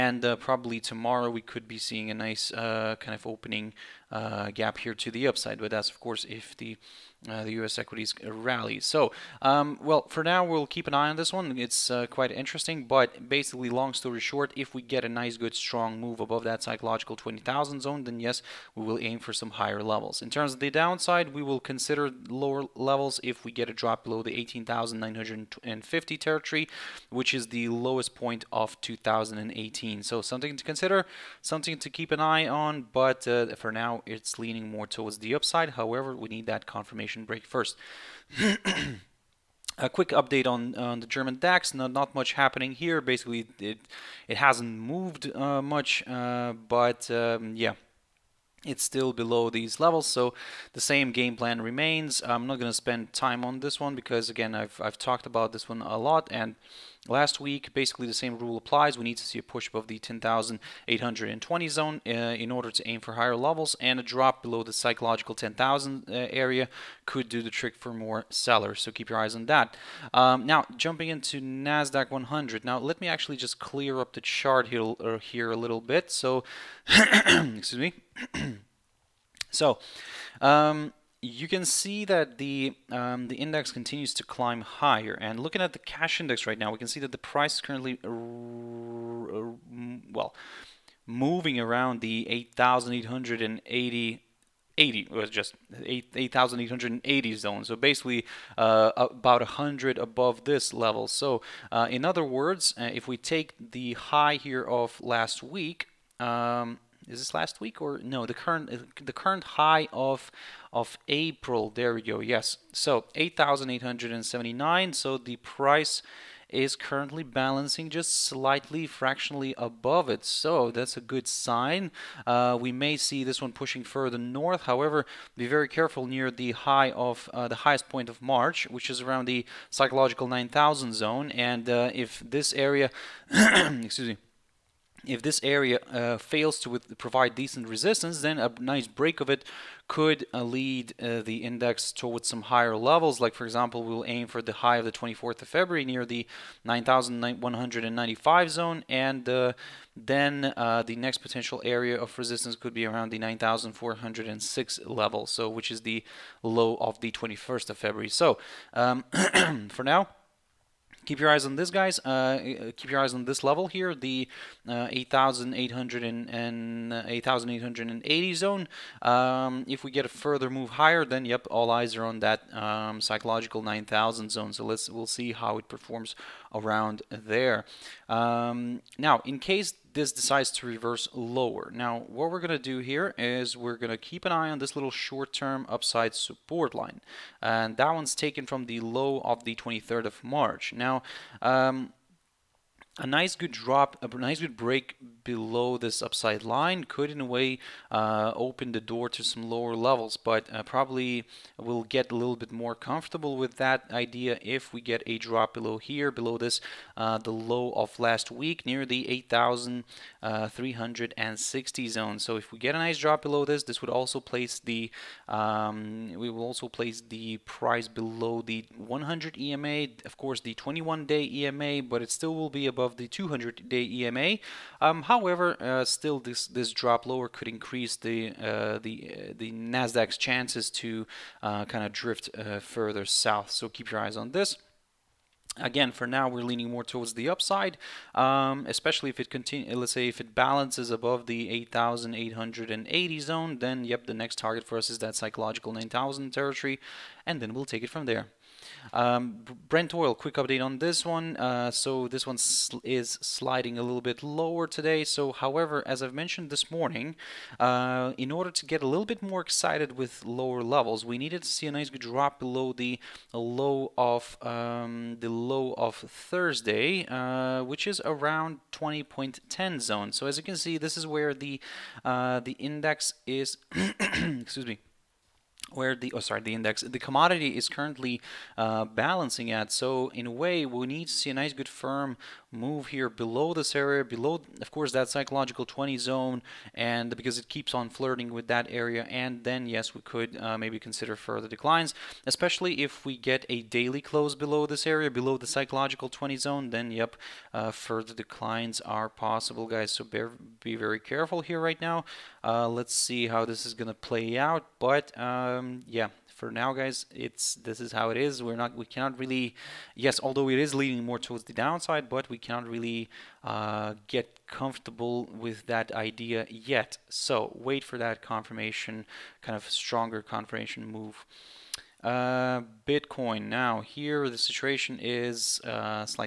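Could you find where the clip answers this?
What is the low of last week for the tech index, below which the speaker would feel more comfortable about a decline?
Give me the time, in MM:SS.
03:29.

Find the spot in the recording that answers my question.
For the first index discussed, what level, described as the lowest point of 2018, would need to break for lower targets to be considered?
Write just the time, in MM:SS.
00:24.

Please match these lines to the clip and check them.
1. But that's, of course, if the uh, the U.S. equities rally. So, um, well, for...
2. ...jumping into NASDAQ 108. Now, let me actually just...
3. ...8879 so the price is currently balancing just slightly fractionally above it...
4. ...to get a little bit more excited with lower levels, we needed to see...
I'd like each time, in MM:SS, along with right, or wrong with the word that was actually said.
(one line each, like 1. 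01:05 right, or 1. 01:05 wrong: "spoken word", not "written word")
1. 00:05 right
2. 01:10 wrong: "100", not "108"
3. 01:53 right
4. 04:18 right.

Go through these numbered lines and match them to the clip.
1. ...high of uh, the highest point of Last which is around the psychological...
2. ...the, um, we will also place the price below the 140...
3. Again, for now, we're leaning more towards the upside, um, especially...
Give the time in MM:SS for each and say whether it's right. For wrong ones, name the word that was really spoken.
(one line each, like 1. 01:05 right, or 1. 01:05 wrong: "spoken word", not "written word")
1. 02:06 wrong: "March", not "Last"
2. 03:34 wrong: "100", not "140"
3. 03:55 right.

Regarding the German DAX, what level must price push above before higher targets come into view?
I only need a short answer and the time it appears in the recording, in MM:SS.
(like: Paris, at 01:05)
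10,820, at 00:59.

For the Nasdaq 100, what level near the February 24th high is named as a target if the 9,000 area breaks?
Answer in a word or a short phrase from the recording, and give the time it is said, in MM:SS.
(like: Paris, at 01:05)
9,195, at 02:26.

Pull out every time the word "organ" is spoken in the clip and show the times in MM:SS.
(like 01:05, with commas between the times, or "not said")
not said.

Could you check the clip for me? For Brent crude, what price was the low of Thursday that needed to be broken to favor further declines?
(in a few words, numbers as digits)
20.10.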